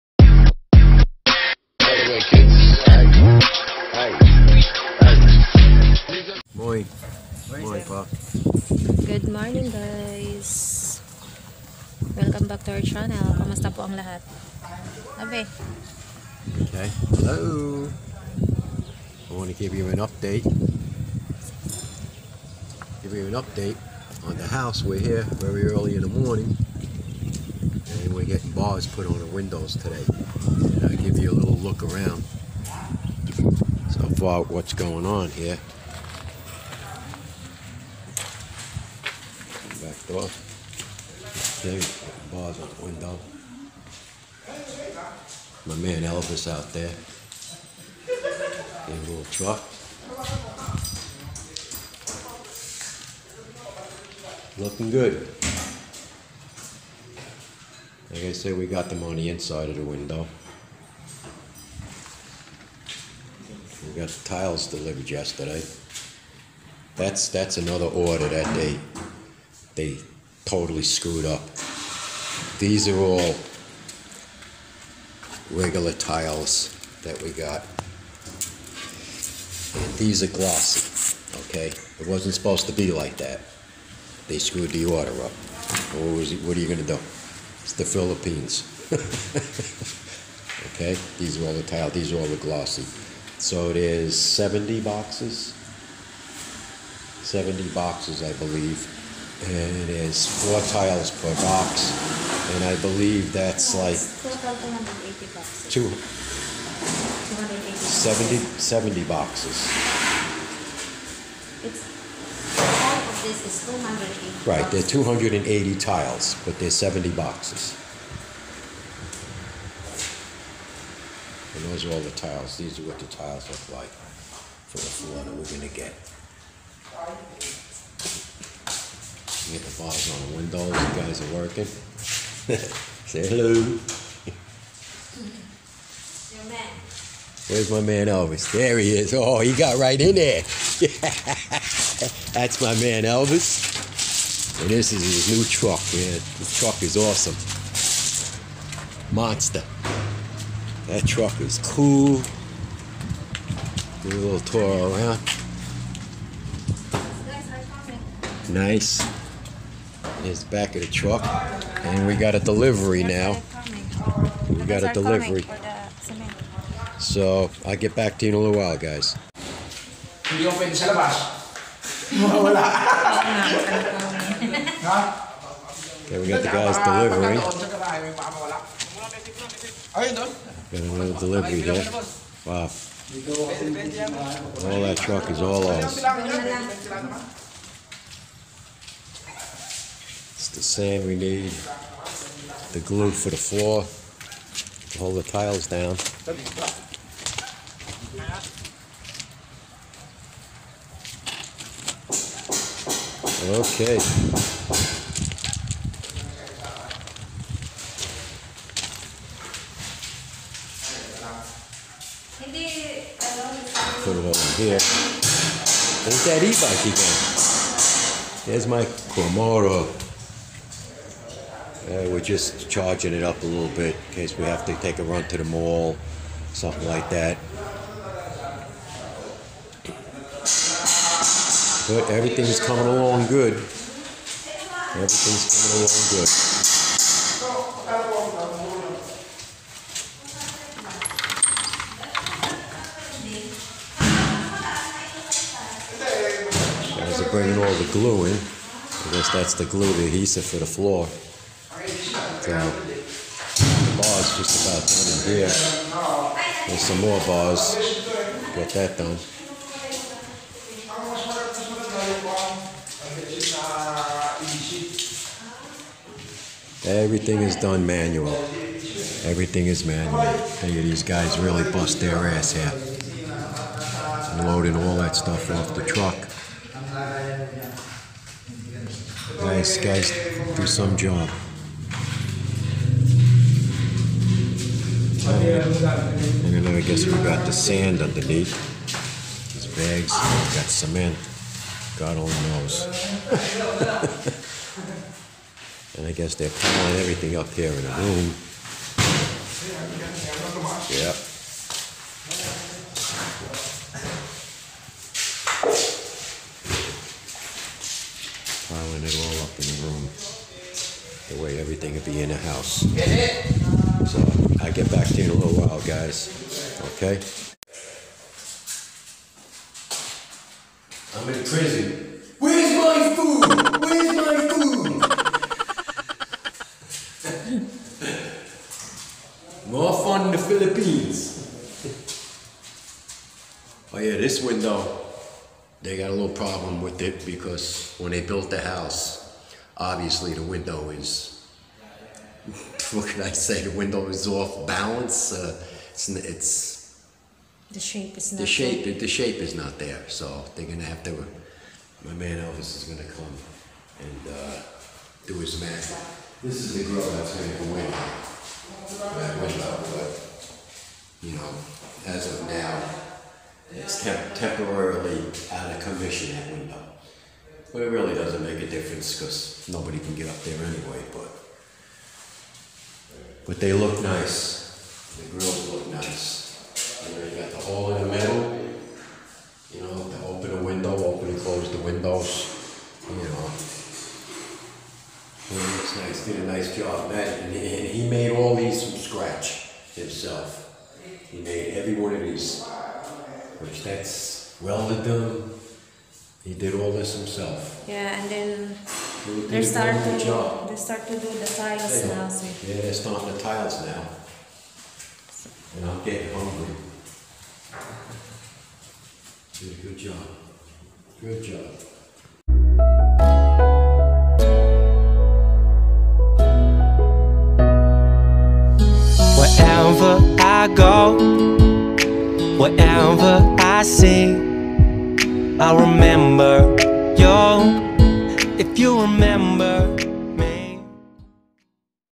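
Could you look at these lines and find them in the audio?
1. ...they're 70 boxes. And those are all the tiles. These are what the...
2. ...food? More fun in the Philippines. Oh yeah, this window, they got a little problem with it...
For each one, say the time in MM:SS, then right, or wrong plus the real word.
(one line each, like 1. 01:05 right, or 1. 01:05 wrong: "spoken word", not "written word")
1. 01:56 right
2. 05:24 right.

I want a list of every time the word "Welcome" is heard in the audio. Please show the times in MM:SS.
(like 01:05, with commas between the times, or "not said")
00:12.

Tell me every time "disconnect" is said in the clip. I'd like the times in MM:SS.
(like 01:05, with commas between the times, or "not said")
not said.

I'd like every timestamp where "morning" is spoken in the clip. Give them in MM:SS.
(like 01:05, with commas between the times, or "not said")
00:09, 00:26.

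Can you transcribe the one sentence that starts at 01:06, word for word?
That's, that's another order that they, they totally screwed up.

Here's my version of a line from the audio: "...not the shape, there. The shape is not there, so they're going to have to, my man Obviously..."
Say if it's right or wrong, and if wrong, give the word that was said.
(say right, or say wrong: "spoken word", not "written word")
wrong: "Elvis", not "Obviously".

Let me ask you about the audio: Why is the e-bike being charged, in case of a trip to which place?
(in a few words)
The mall.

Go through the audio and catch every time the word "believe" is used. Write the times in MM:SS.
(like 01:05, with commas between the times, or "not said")
01:38, 01:42.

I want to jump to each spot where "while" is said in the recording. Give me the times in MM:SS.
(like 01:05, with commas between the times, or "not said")
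02:48, 05:15.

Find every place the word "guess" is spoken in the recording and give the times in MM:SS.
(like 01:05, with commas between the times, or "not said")
04:09, 04:46, 04:56.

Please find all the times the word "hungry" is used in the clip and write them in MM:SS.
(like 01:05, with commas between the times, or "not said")
06:46.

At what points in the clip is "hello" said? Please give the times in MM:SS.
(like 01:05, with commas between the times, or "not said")
00:17, 02:13.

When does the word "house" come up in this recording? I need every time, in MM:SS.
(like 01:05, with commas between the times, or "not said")
00:24, 05:12, 05:38.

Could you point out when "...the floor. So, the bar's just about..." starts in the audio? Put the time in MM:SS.
04:10.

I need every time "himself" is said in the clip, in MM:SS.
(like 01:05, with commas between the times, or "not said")
06:29, 06:37.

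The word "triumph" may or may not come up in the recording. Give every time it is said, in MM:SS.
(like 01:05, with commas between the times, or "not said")
not said.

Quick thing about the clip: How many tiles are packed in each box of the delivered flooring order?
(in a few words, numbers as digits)
4.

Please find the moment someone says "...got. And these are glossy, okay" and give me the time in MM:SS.
01:17.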